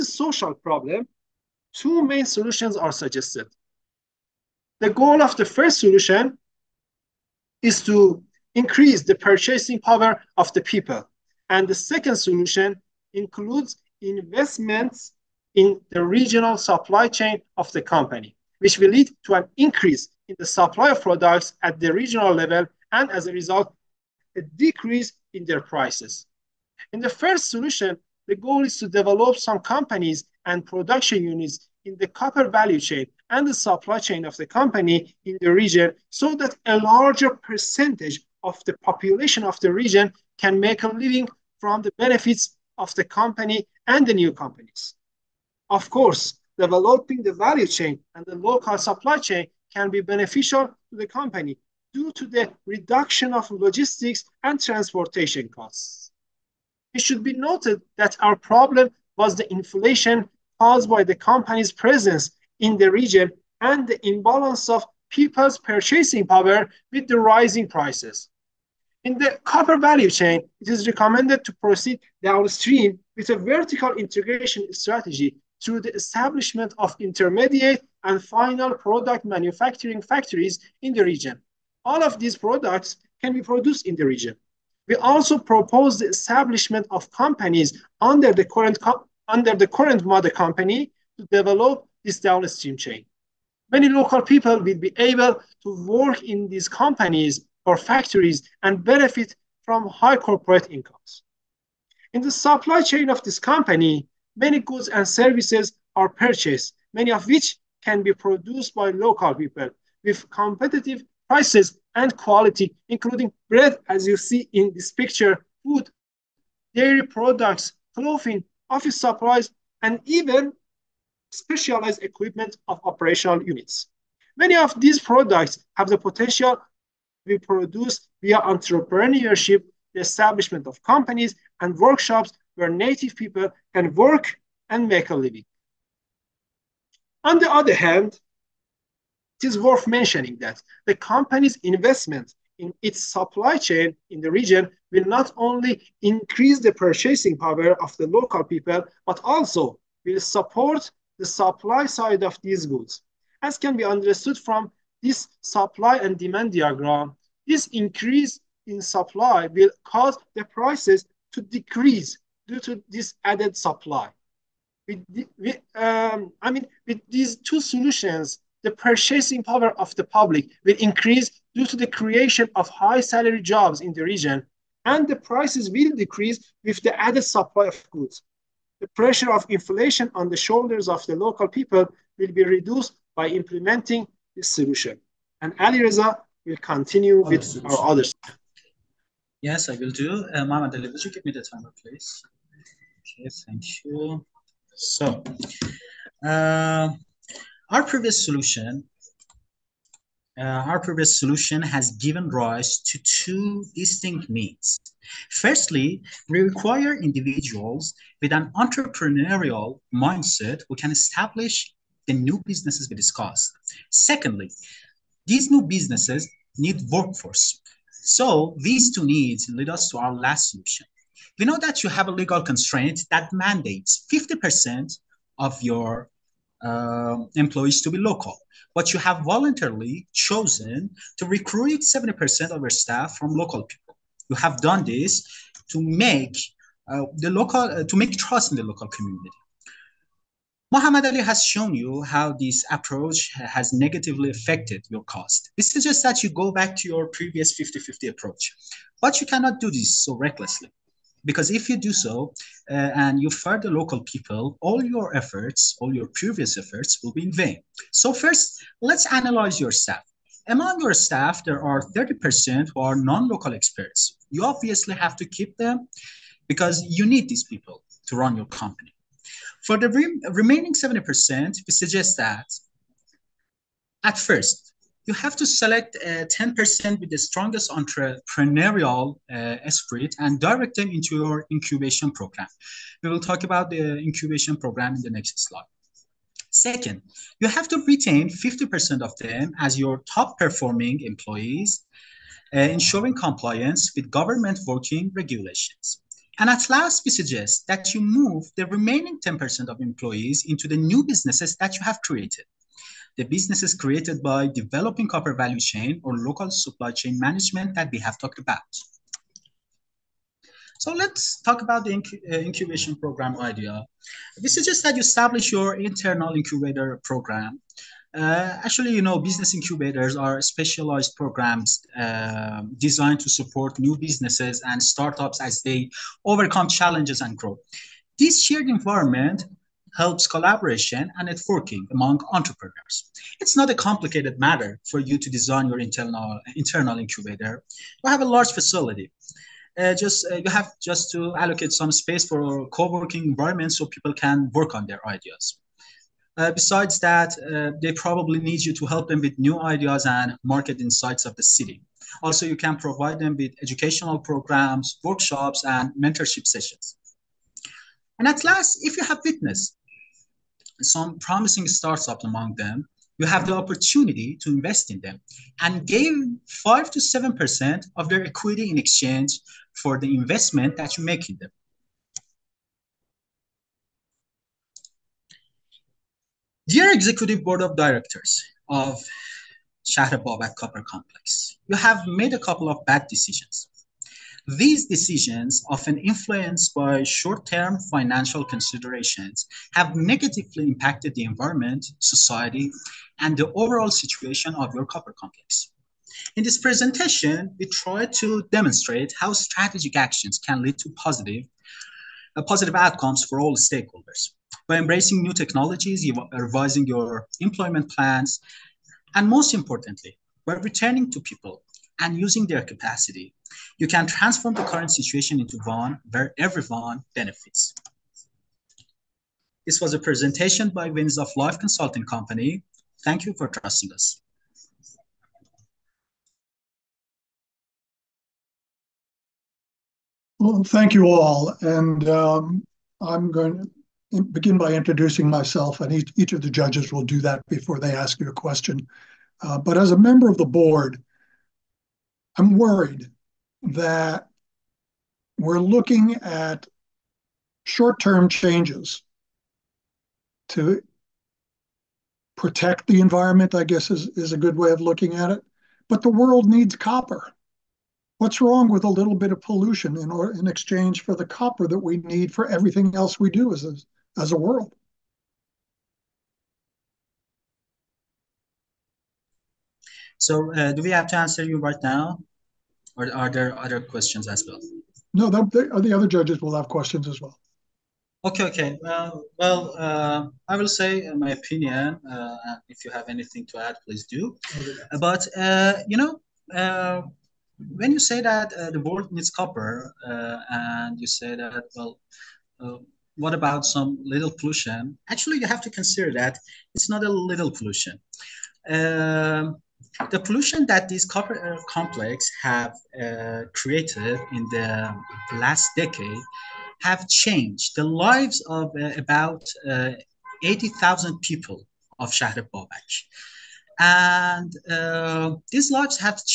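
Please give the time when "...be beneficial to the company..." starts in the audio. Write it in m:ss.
0:49.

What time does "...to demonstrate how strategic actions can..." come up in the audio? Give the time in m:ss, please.
6:38.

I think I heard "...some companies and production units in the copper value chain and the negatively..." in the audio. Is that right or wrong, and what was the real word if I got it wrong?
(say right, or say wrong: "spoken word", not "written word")
wrong: "supply", not "negatively".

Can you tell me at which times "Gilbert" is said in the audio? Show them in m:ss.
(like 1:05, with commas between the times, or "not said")
not said.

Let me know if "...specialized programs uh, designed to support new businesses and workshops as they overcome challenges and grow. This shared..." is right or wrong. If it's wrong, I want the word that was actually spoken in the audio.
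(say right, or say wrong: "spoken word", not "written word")
wrong: "startups", not "workshops".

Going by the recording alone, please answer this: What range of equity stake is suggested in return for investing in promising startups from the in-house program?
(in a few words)
5 to 7%.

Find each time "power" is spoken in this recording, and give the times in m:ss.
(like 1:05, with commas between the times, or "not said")
0:09, 1:06, 2:27, 2:49.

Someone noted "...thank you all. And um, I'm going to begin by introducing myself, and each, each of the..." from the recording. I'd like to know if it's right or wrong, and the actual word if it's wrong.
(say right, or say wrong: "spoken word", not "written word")
right.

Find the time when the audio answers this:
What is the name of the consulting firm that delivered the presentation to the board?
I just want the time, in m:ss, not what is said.
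7:00.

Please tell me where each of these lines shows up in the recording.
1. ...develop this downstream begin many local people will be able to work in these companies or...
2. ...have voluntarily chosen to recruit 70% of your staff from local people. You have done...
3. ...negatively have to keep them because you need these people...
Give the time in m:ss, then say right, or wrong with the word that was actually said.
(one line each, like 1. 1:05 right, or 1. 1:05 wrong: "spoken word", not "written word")
1. 1:31 wrong: "chain", not "begin"
2. 3:48 right
3. 4:24 wrong: "obviously", not "negatively".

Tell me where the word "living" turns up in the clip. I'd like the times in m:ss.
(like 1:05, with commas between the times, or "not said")
0:40, 2:15.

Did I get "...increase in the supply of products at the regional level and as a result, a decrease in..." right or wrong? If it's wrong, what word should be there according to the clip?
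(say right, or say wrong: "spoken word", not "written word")
right.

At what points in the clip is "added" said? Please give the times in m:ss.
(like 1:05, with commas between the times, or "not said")
2:43, 2:56.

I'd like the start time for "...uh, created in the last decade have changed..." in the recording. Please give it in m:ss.
8:23.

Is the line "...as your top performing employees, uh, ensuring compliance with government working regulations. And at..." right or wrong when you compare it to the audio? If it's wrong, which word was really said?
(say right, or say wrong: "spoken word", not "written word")
right.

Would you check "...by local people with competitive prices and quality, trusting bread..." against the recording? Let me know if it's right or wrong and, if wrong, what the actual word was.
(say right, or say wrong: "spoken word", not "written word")
wrong: "including", not "trusting".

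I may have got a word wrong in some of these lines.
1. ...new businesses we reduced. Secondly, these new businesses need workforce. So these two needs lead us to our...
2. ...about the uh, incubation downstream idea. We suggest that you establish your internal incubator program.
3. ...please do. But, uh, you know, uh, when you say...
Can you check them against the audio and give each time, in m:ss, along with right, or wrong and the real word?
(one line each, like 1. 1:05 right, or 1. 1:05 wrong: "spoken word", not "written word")
1. 3:32 wrong: "discussed", not "reduced"
2. 5:11 wrong: "program", not "downstream"
3. 8:03 right.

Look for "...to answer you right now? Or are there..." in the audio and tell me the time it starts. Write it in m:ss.
7:51.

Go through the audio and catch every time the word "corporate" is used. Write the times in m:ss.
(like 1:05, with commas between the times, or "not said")
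1:40, 8:21.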